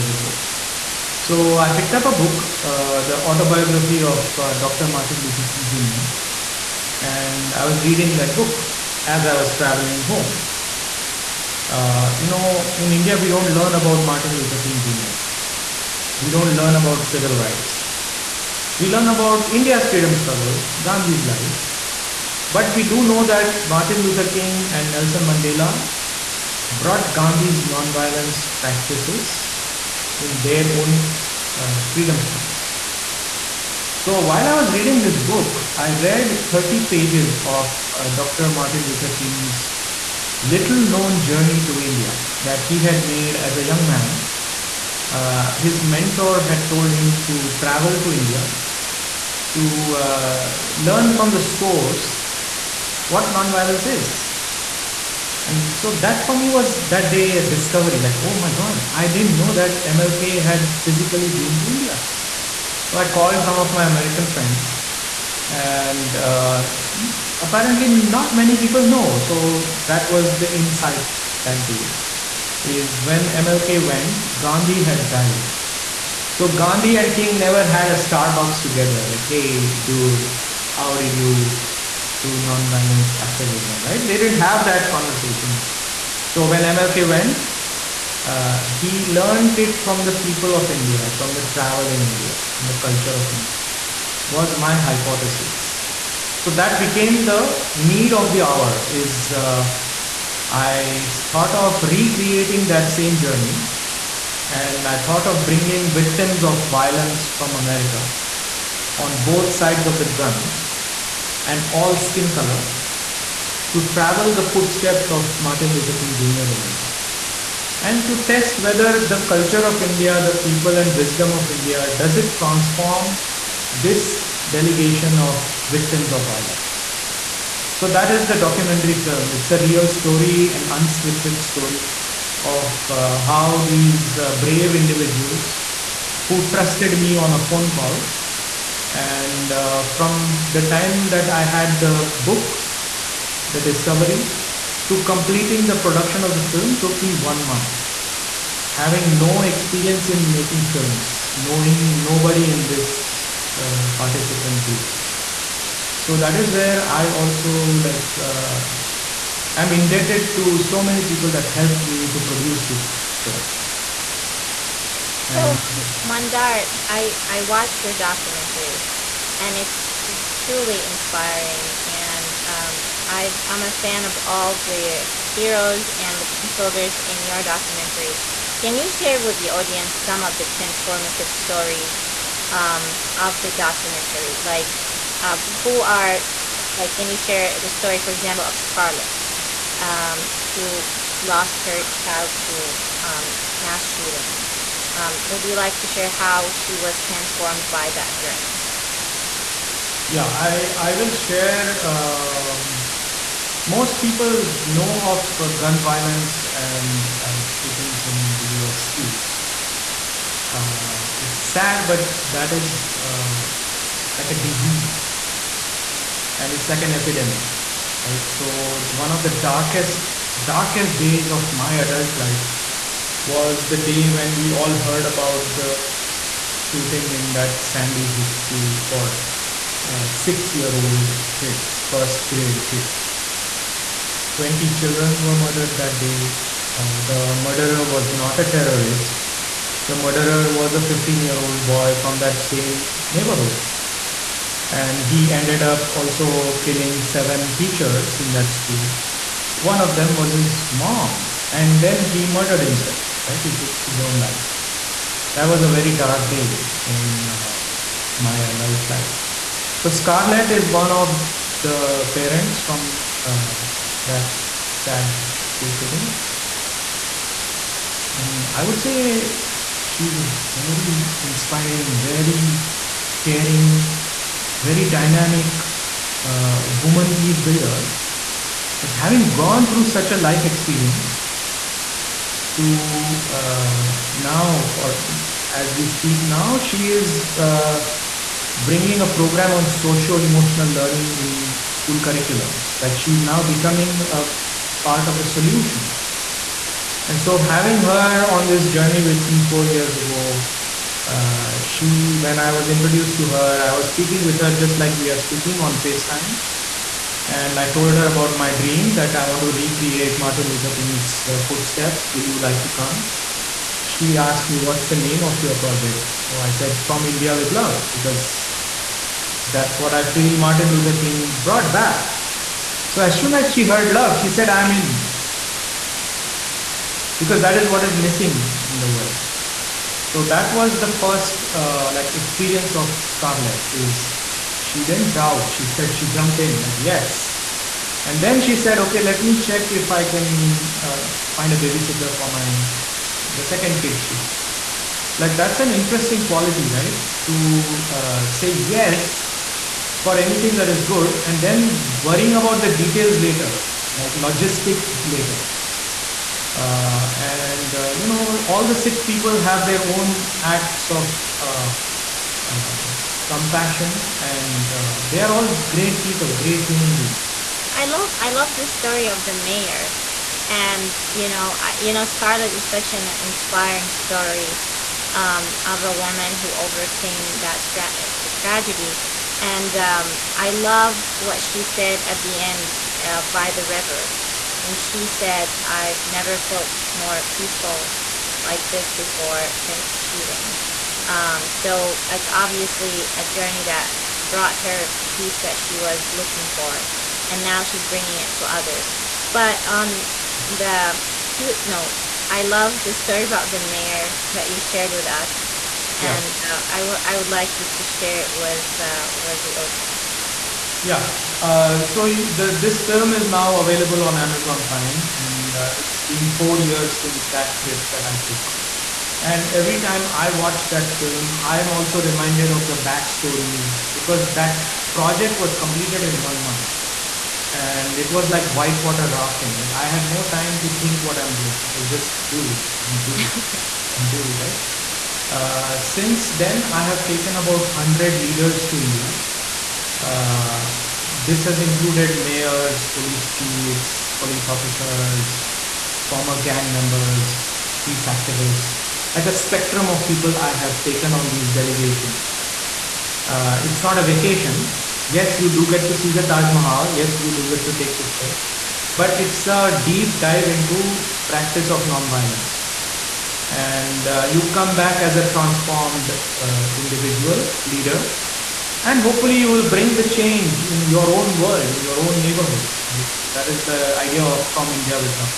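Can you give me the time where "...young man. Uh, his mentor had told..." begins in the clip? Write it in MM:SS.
00:43.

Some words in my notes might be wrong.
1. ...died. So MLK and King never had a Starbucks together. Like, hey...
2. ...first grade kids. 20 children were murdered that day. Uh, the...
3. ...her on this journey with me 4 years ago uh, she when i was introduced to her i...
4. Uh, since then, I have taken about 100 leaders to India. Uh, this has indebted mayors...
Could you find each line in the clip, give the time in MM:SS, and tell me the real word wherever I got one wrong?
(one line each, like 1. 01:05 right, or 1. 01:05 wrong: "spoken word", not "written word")
1. 01:15 wrong: "Gandhi", not "MLK"
2. 03:51 right
3. 04:57 right
4. 07:15 wrong: "included", not "indebted".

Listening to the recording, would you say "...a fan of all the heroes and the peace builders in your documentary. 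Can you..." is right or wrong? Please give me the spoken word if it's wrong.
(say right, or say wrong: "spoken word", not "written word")
right.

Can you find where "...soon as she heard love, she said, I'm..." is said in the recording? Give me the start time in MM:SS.
05:23.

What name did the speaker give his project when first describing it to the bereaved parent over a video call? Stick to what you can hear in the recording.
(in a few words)
From India with Love.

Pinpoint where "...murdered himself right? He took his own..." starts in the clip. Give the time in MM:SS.
04:12.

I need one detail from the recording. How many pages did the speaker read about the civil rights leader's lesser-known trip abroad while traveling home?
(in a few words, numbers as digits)
30.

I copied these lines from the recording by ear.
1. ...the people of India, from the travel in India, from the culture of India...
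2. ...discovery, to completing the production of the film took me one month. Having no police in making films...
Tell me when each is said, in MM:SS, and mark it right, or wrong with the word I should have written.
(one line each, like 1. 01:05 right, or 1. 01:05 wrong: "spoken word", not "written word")
1. 01:30 right
2. 02:23 wrong: "experience", not "police".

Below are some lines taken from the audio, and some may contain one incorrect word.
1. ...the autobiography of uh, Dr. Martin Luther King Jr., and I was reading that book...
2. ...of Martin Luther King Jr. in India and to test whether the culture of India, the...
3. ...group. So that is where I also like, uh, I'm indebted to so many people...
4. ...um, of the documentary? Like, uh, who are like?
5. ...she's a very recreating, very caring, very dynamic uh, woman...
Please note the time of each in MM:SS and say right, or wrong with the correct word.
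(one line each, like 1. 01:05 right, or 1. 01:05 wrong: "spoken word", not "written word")
1. 00:03 right
2. 01:55 right
3. 02:34 right
4. 03:02 right
5. 04:29 wrong: "inspiring", not "recreating".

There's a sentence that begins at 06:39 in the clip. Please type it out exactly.
But on the cute note, I love the story about the mayor that you shared with us, and yeah.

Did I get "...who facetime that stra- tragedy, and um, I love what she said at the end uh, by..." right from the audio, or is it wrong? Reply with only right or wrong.
wrong.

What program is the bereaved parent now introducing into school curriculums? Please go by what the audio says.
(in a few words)
socio emotional learning.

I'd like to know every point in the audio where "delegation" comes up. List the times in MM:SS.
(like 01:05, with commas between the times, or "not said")
02:04, 07:31.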